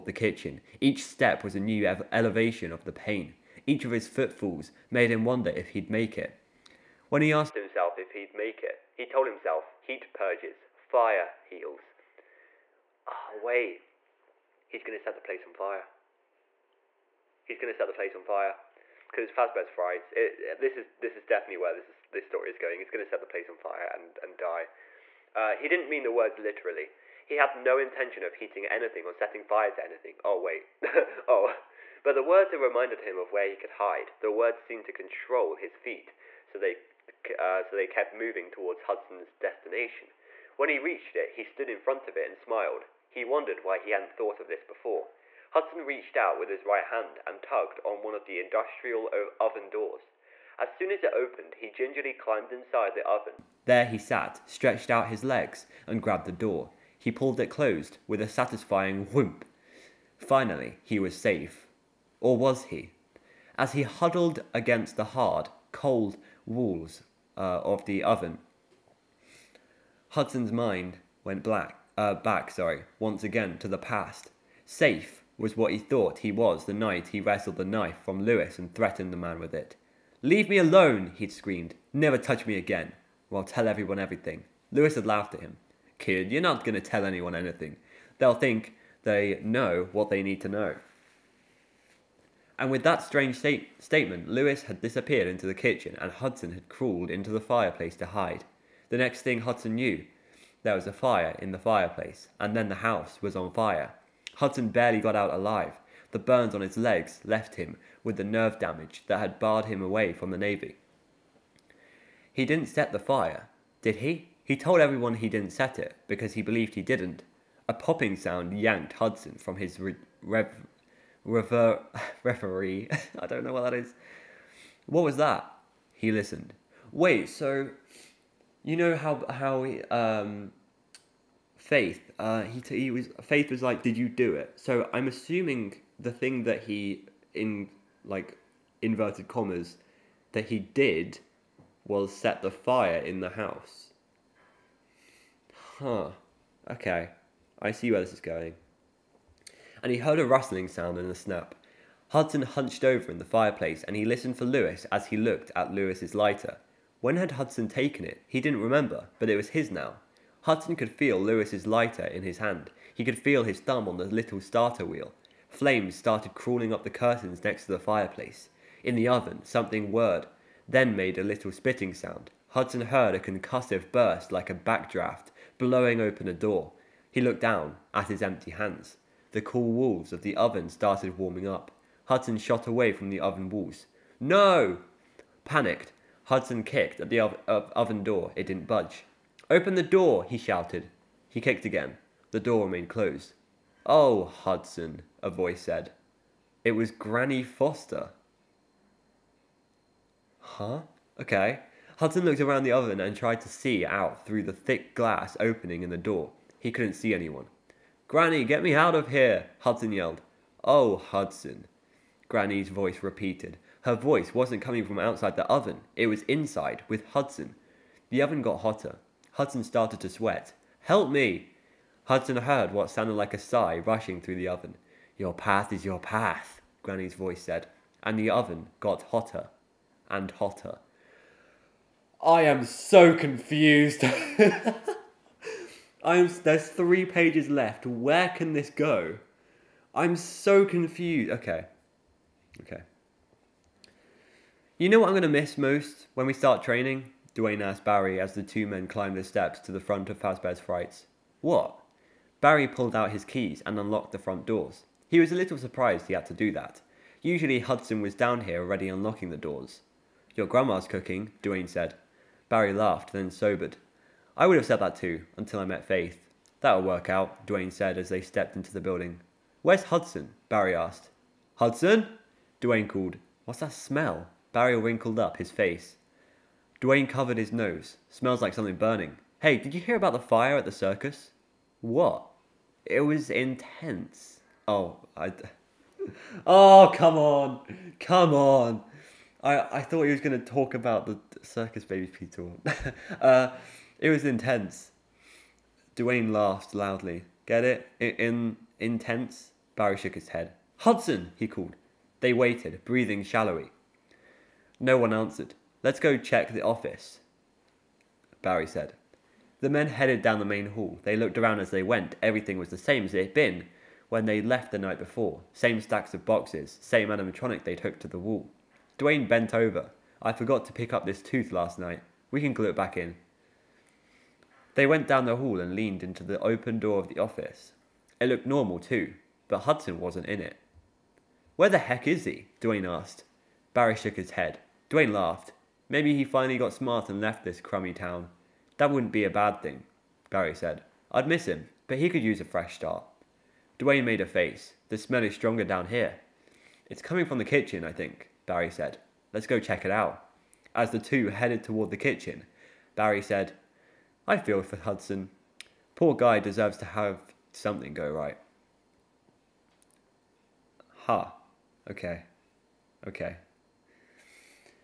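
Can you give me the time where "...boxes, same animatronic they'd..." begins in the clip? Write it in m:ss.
5:16.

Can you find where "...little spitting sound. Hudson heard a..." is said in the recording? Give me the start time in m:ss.
2:51.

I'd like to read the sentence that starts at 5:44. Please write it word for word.
The smell is stronger down here.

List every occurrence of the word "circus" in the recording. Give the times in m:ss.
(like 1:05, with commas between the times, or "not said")
4:40, 4:51.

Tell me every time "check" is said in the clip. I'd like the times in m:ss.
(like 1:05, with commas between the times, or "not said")
5:06, 5:49.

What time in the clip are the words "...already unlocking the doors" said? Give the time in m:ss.
4:18.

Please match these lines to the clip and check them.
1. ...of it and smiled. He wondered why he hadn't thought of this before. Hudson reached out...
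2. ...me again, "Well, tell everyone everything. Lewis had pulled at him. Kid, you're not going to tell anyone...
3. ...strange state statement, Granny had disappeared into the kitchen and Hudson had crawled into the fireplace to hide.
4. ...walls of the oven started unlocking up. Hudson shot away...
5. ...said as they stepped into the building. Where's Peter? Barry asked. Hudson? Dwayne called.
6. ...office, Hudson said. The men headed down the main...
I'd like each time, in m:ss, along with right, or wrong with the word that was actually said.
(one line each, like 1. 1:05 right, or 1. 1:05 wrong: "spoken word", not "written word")
1. 0:42 right
2. 1:22 wrong: "laughed", not "pulled"
3. 1:33 wrong: "Lewis", not "Granny"
4. 2:59 wrong: "warming", not "unlocking"
5. 4:27 wrong: "Hudson", not "Peter"
6. 5:06 wrong: "Barry", not "Hudson".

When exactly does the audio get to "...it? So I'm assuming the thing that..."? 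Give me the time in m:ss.
2:14.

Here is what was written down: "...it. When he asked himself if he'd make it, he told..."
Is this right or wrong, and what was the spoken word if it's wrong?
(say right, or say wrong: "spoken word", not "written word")
right.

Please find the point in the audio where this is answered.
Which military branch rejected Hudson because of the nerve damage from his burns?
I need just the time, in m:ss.
1:50.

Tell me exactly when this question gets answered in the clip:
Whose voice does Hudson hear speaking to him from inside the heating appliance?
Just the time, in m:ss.
3:16.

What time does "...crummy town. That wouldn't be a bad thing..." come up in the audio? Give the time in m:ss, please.
5:37.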